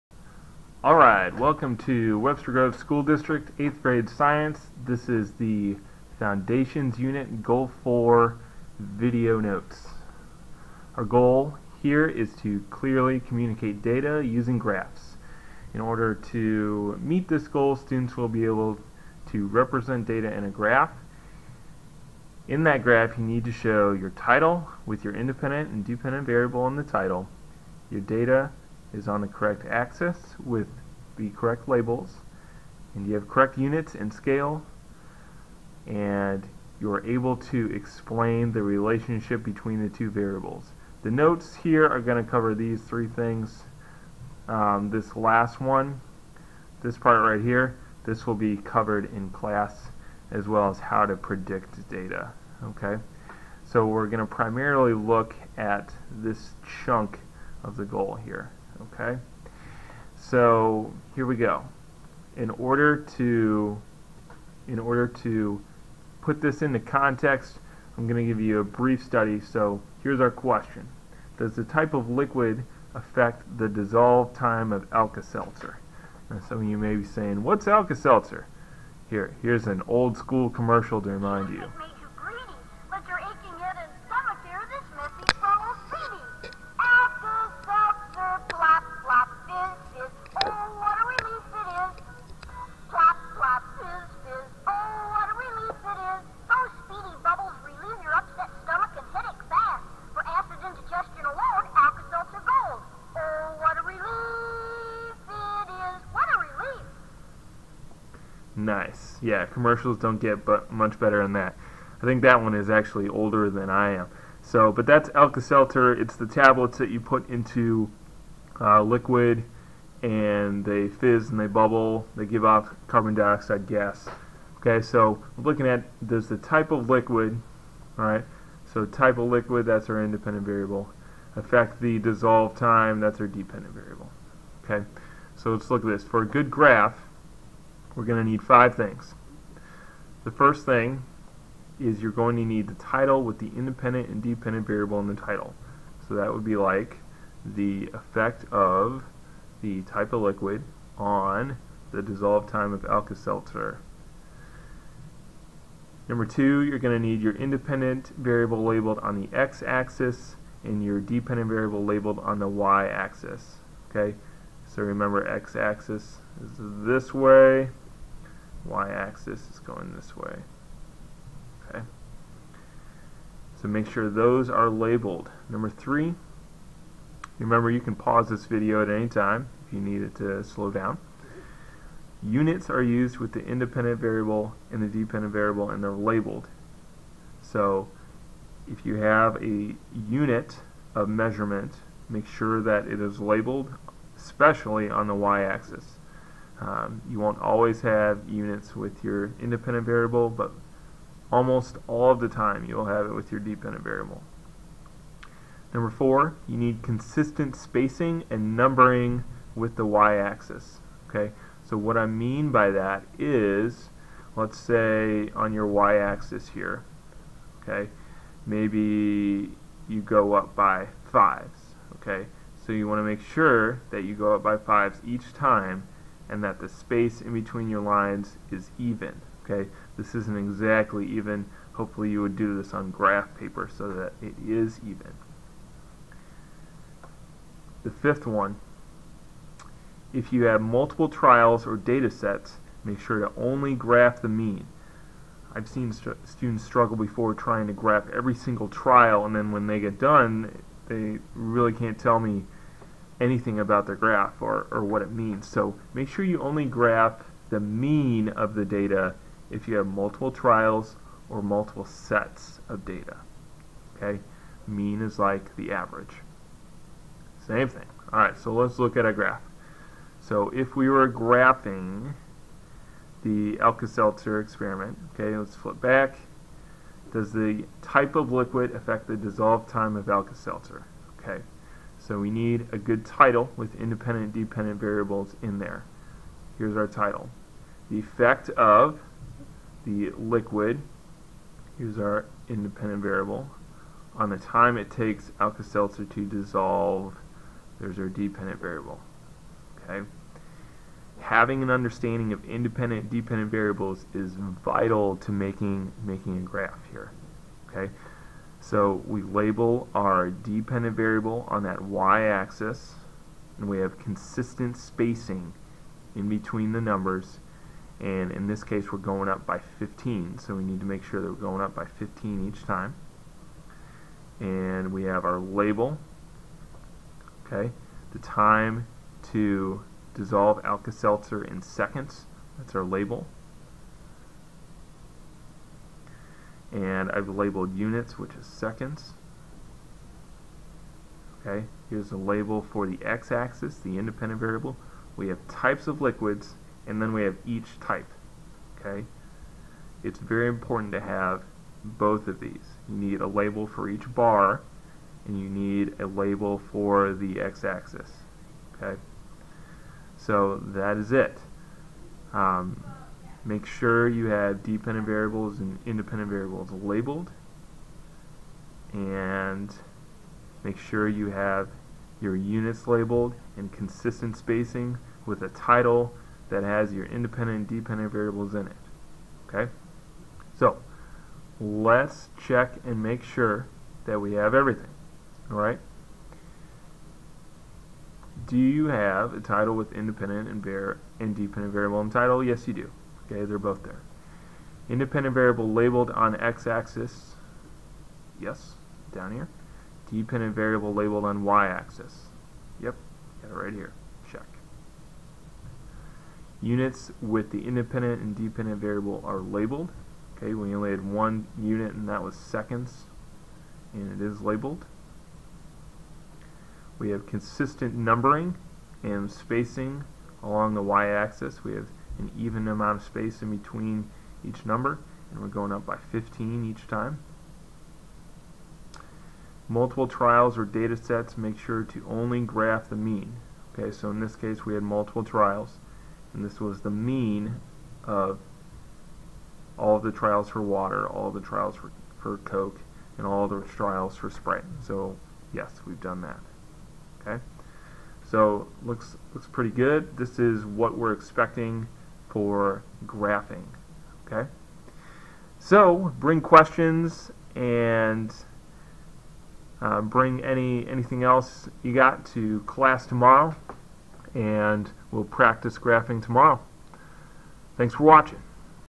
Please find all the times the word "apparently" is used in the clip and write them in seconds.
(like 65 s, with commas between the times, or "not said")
not said.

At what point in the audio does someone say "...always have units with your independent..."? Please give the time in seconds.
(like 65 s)
197 s.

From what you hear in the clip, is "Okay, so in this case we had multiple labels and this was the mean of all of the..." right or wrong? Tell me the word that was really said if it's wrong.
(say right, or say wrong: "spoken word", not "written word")
wrong: "trials", not "labels".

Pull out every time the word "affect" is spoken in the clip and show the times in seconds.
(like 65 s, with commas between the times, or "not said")
72 s, 131 s, 278 s.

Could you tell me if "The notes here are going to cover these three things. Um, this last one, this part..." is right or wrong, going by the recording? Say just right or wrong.
right.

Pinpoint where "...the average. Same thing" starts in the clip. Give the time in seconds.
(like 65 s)
265 s.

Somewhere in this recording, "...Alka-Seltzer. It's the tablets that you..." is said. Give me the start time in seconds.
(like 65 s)
115 s.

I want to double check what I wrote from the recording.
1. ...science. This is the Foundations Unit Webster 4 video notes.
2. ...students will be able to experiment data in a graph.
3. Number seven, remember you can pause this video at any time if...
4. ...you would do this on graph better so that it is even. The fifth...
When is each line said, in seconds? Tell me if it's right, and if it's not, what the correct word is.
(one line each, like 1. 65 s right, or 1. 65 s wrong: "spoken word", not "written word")
1. 4 s wrong: "Goal", not "Webster"
2. 17 s wrong: "represent", not "experiment"
3. 175 s wrong: "three", not "seven"
4. 232 s wrong: "paper", not "better".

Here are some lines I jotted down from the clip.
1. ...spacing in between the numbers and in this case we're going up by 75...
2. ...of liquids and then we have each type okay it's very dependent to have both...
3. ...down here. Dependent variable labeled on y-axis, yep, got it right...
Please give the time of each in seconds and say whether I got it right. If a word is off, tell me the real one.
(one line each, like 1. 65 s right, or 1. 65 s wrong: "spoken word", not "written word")
1. 314 s wrong: "15", not "75"
2. 345 s wrong: "important", not "dependent"
3. 399 s right.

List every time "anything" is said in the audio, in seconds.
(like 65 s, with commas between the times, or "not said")
253 s, 460 s.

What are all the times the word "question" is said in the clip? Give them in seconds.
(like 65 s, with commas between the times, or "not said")
70 s, 456 s.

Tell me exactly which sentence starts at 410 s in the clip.
Okay, we only had one unit and that was seconds, and it is labeled.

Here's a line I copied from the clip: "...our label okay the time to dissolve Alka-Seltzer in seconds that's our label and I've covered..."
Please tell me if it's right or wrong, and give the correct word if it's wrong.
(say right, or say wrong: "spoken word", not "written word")
wrong: "labeled", not "covered".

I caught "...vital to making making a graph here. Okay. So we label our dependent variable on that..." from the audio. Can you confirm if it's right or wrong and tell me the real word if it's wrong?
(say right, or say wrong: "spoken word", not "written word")
right.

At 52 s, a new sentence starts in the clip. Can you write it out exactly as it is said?
Okay, So we're going to primarily look at this chunk of the goal here.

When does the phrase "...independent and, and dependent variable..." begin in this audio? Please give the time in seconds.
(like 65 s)
389 s.